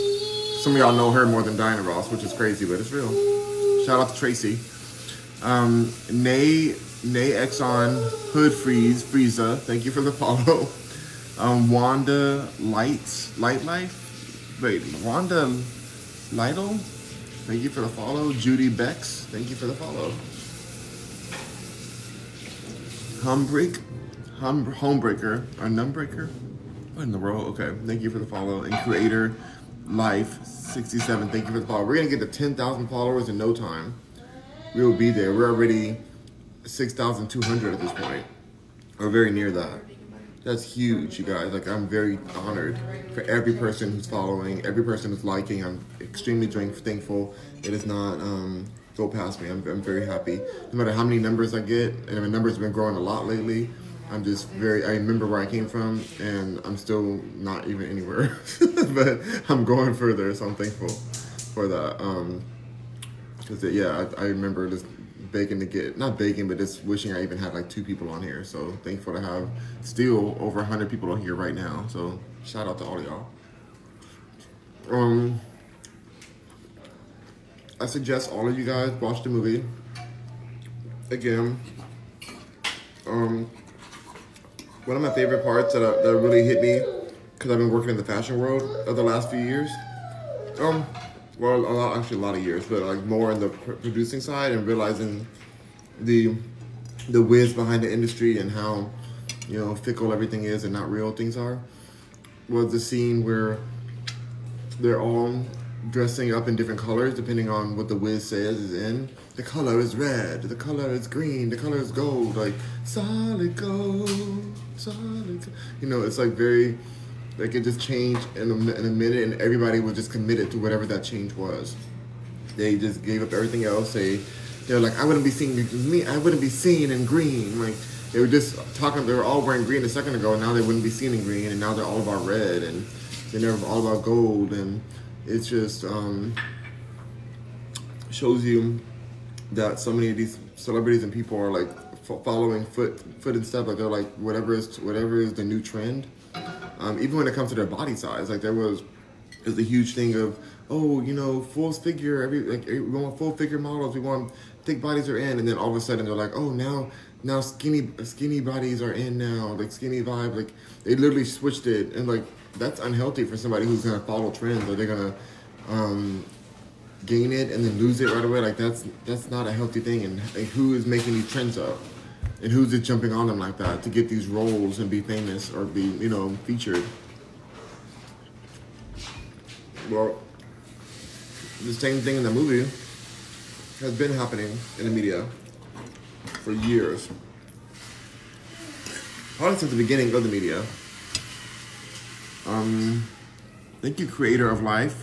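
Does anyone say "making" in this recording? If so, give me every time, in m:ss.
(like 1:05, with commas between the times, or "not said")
2:50.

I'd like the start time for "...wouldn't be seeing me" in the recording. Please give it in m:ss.
2:05.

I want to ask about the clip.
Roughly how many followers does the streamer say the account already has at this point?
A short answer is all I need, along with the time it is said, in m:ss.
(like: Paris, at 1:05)
6,200, at 0:36.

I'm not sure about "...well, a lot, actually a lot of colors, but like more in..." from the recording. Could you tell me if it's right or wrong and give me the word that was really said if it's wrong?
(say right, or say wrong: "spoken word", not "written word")
wrong: "years", not "colors".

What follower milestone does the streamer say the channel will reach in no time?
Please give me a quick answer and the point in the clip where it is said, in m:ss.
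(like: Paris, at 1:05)
10,000, at 0:32.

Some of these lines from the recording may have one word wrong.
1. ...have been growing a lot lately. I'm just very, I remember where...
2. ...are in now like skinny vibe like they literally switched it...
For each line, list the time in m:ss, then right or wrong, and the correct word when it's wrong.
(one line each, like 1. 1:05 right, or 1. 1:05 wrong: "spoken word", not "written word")
1. 0:52 right
2. 2:38 right.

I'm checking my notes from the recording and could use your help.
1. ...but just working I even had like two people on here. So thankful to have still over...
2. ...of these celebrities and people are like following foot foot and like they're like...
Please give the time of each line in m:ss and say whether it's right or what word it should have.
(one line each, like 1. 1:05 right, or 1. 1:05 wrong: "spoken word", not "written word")
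1. 1:06 wrong: "wishing", not "working"
2. 2:20 right.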